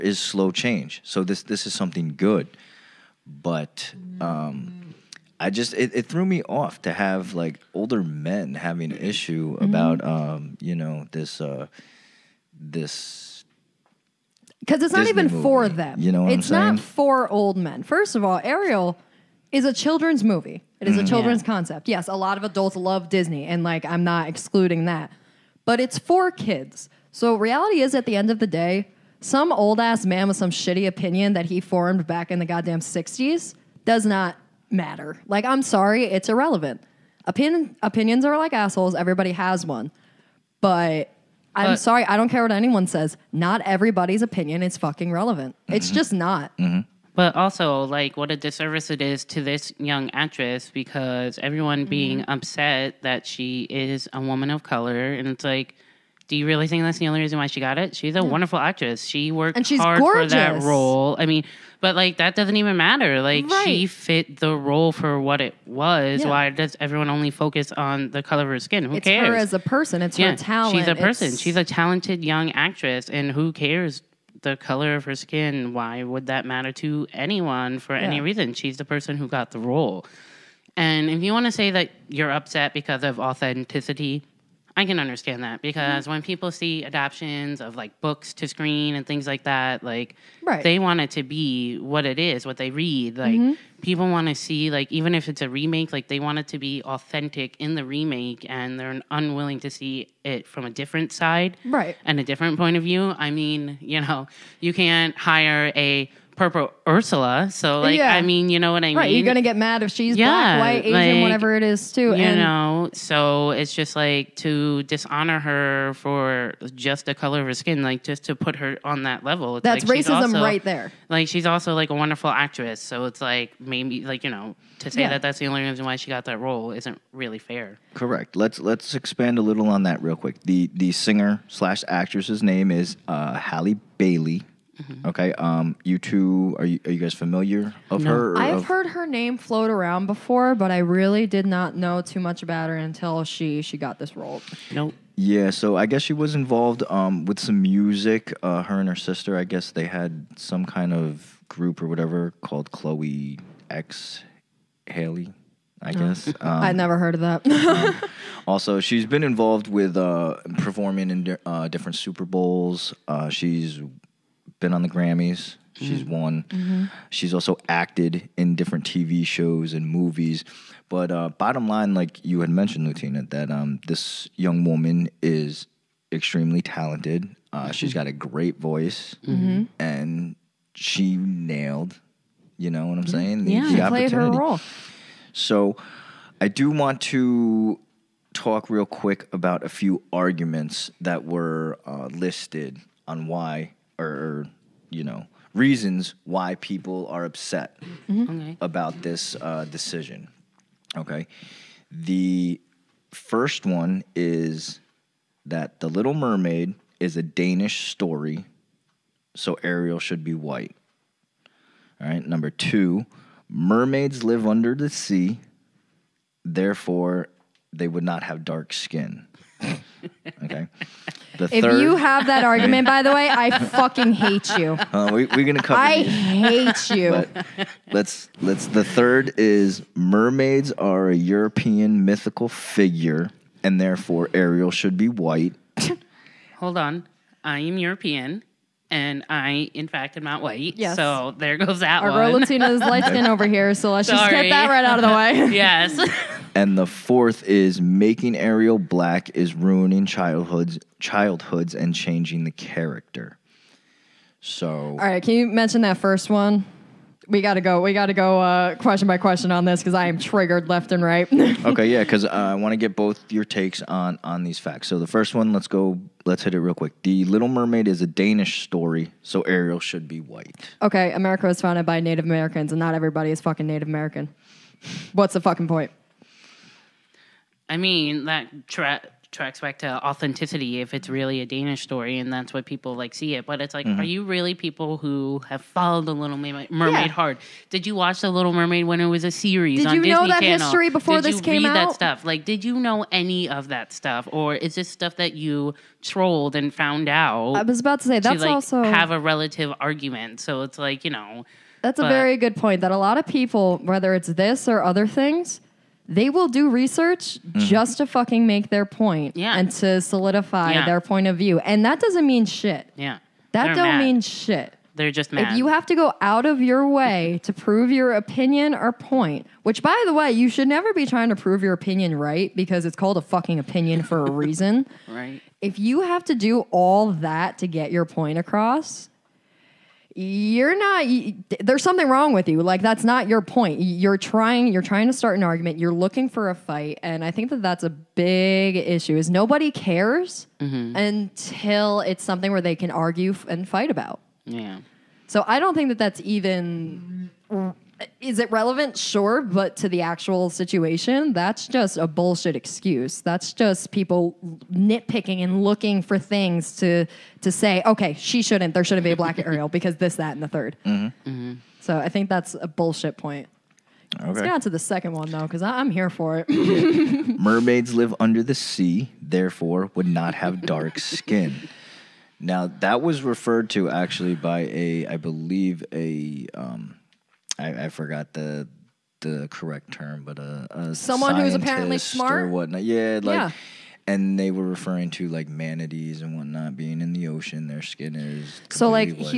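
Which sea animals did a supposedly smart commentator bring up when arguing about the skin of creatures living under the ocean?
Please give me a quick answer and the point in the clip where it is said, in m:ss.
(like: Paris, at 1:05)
manatees, at 6:25.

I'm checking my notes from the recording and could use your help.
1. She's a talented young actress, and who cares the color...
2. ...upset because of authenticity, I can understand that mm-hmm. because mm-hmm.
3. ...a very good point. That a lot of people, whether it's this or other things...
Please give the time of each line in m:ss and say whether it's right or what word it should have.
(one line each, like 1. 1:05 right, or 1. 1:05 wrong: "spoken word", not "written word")
1. 1:11 right
2. 1:22 right
3. 5:02 right.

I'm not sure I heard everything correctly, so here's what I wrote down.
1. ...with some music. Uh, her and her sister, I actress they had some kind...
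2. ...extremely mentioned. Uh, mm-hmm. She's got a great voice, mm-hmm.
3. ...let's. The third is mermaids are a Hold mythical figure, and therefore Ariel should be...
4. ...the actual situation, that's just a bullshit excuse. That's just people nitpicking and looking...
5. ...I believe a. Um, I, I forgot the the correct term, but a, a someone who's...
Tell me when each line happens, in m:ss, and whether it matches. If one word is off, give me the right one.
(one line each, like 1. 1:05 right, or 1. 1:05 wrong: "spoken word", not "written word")
1. 2:27 wrong: "guess", not "actress"
2. 2:56 wrong: "talented", not "mentioned"
3. 3:48 wrong: "European", not "Hold"
4. 5:49 right
5. 6:15 right.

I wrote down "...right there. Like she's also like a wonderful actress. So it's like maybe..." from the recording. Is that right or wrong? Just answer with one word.
right.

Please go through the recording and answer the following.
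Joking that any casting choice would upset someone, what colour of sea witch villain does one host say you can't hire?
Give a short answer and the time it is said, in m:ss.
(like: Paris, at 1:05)
Purple, at 1:46.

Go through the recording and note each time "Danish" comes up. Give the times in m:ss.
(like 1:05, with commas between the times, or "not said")
3:27, 4:28, 4:41.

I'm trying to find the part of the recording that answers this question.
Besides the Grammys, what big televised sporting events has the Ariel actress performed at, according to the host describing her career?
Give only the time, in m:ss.
2:41.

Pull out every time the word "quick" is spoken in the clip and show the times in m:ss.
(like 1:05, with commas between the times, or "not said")
2:10, 3:08, 4:26.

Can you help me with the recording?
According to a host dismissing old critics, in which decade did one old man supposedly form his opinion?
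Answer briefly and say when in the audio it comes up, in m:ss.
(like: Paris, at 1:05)
the 60s, at 0:32.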